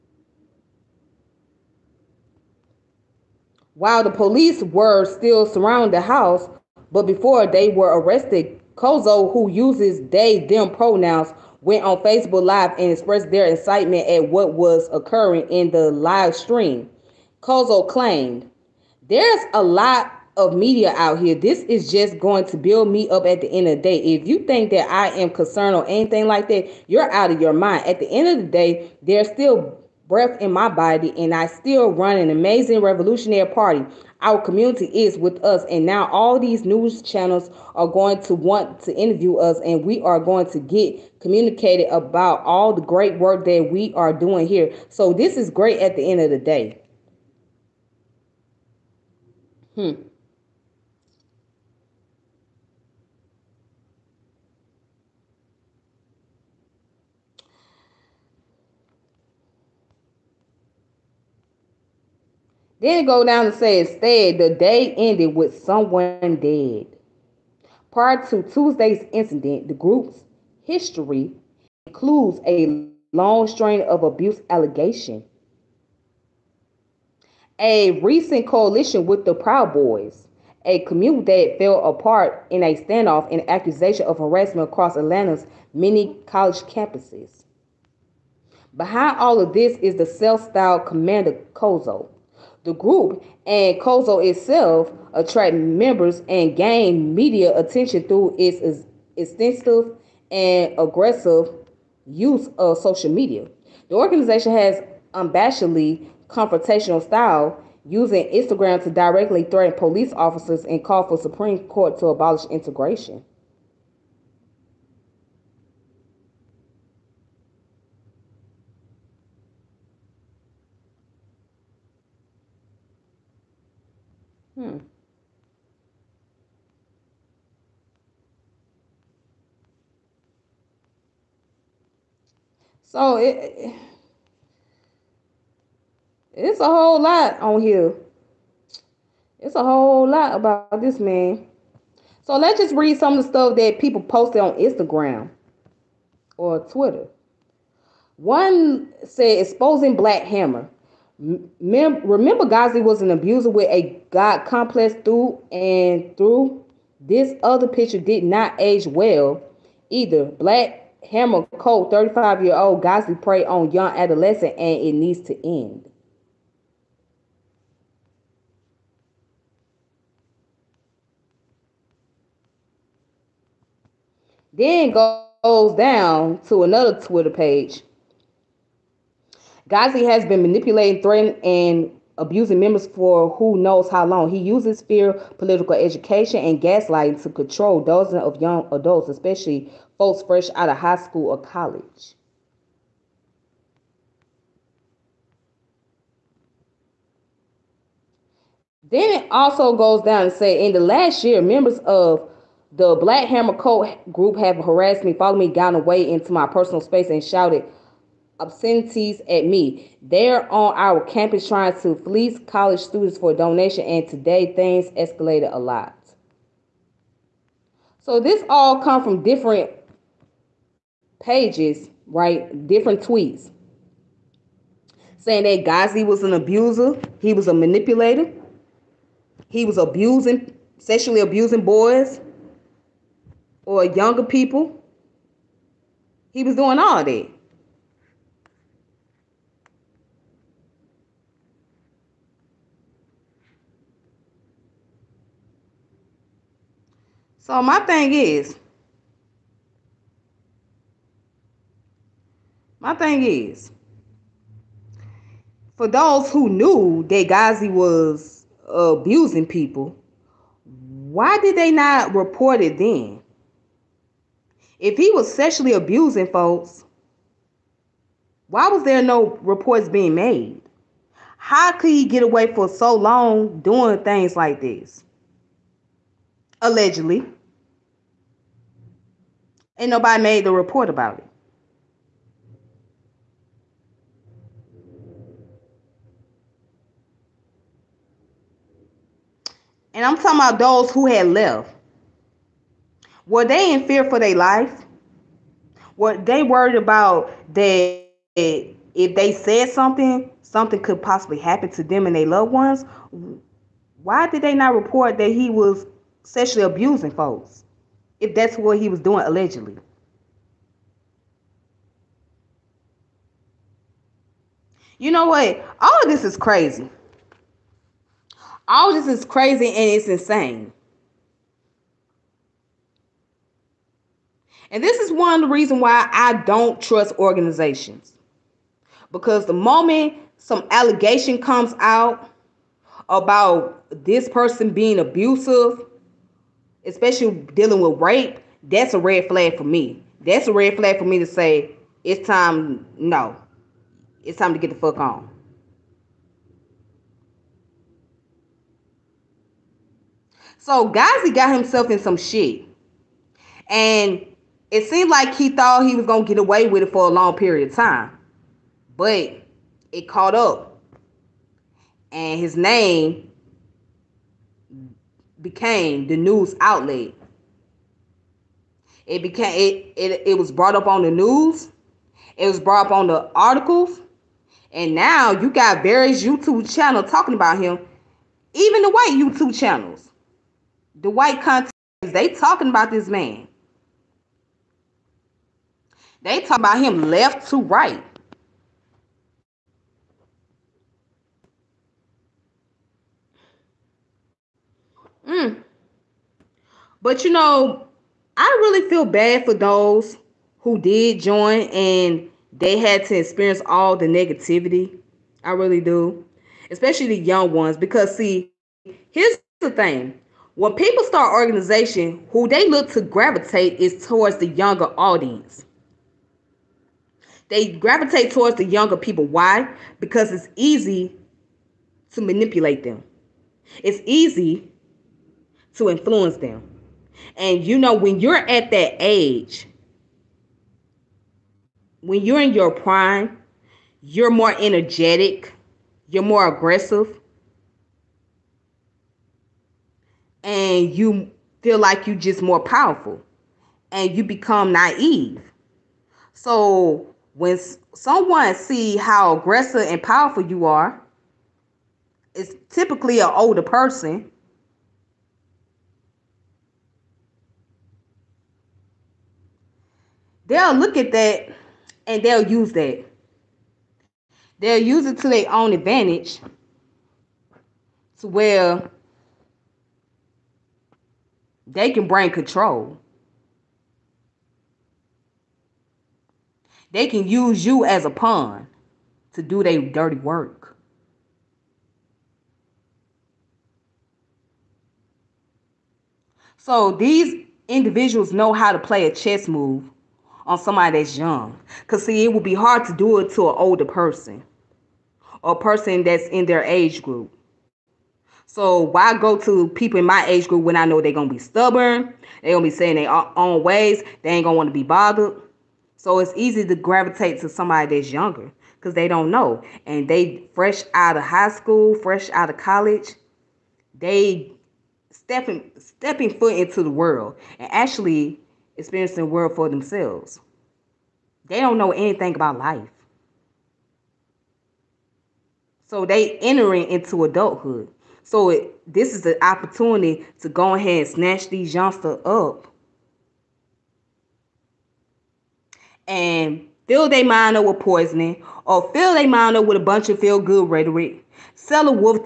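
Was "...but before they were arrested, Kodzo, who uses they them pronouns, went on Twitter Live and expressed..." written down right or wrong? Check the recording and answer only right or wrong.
wrong.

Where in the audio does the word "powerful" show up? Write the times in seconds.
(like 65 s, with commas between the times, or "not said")
442 s, 450 s.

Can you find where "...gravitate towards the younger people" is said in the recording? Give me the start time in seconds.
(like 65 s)
417 s.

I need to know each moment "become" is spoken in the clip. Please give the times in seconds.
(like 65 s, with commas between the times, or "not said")
444 s.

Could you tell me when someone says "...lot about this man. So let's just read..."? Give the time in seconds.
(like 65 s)
140 s.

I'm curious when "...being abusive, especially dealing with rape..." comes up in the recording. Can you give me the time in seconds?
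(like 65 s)
334 s.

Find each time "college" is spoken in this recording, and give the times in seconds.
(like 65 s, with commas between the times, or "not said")
86 s, 191 s, 212 s, 512 s.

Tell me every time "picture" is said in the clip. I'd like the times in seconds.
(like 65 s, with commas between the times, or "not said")
157 s.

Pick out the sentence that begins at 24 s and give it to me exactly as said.
If you think that I am concerned or anything like that, you're out of your mind.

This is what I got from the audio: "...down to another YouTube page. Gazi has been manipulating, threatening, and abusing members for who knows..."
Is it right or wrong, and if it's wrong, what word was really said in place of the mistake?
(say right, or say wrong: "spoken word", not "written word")
wrong: "Twitter", not "YouTube".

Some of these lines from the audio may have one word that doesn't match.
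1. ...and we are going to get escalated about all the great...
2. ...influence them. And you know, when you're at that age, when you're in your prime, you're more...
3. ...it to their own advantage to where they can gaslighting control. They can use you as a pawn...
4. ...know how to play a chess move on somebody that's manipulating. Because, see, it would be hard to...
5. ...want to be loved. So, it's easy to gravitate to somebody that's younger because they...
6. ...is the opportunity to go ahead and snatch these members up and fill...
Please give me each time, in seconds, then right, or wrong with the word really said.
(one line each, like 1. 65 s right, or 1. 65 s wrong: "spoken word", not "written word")
1. 39 s wrong: "communicated", not "escalated"
2. 425 s right
3. 465 s wrong: "bring", not "gaslighting"
4. 488 s wrong: "young", not "manipulating"
5. 504 s wrong: "bothered", not "loved"
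6. 529 s wrong: "youngsters", not "members".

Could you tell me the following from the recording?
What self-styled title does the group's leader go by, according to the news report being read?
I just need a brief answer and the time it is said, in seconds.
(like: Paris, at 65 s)
Commander Kodzo, at 90 s.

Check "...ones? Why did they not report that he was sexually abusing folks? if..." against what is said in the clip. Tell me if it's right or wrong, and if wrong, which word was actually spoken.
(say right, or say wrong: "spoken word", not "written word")
right.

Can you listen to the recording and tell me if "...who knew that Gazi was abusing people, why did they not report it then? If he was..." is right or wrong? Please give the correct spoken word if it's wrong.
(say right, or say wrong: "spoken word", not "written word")
right.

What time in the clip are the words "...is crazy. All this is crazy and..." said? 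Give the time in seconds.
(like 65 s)
316 s.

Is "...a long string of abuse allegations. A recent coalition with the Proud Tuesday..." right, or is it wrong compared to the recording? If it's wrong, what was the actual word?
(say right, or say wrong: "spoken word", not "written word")
wrong: "Boys", not "Tuesday".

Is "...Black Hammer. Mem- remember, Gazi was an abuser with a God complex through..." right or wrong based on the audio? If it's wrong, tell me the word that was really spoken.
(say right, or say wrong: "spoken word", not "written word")
right.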